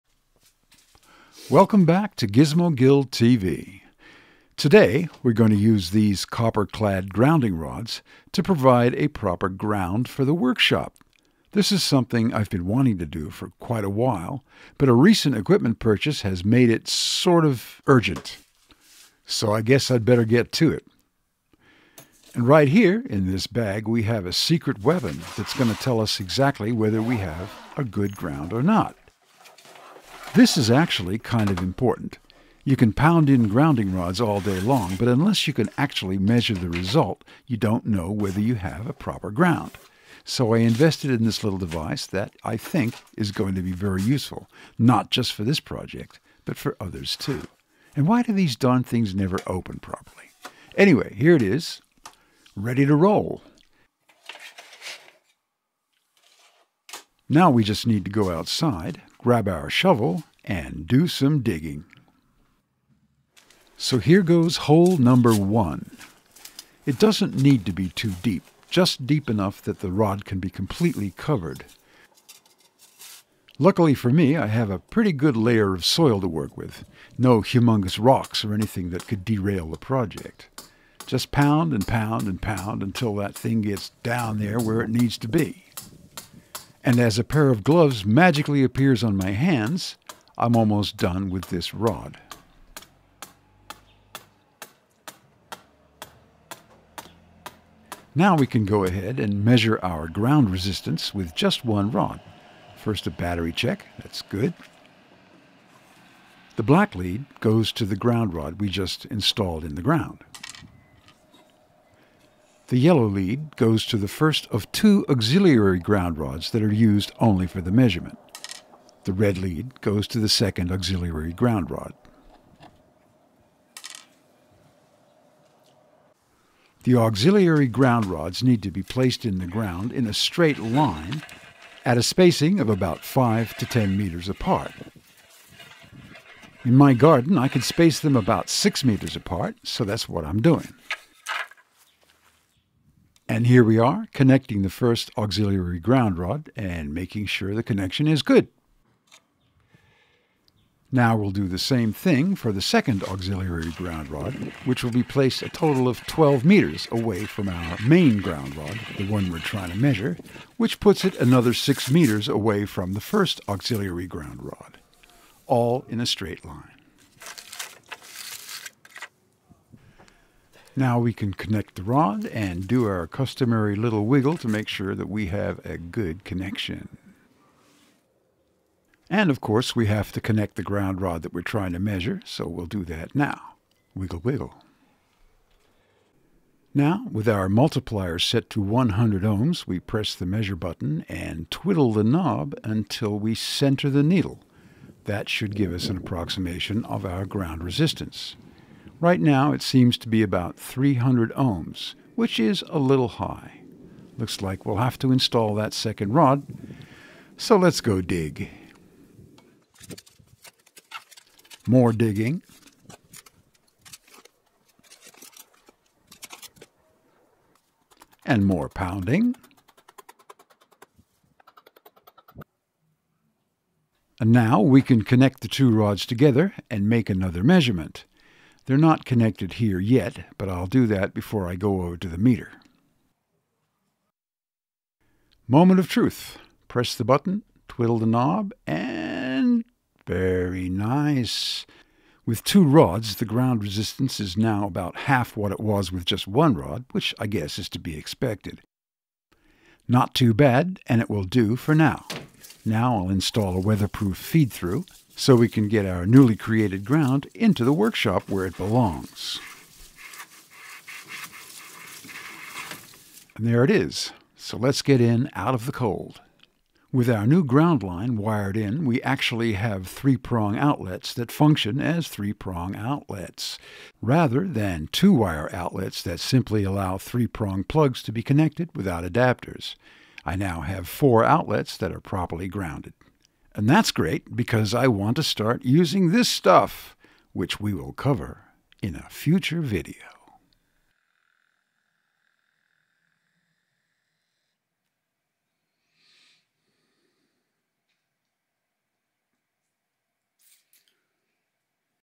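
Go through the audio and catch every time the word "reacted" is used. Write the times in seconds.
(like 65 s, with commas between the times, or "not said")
not said.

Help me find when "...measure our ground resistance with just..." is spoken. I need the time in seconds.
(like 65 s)
99 s.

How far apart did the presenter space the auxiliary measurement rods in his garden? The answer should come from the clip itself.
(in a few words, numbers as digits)
About 6 meters.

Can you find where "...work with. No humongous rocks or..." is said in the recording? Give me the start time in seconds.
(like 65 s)
76 s.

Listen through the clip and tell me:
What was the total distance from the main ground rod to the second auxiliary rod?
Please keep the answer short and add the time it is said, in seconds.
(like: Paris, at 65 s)
12 meters, at 156 s.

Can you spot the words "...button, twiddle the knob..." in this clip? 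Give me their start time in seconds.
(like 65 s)
237 s.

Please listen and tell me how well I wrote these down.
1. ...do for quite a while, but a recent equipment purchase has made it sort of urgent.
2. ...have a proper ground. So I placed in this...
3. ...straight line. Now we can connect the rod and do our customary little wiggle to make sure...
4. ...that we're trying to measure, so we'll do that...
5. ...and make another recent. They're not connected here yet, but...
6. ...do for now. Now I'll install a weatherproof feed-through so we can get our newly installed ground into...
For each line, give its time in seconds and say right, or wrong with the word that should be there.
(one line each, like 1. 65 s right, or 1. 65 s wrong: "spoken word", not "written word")
1. 13 s right
2. 38 s wrong: "invested", not "placed"
3. 166 s right
4. 181 s right
5. 226 s wrong: "measurement", not "recent"
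6. 251 s wrong: "created", not "installed".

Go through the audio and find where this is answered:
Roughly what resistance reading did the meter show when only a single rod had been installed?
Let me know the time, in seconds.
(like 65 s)
200 s.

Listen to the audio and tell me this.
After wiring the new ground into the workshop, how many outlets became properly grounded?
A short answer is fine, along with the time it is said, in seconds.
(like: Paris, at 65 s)
4, at 280 s.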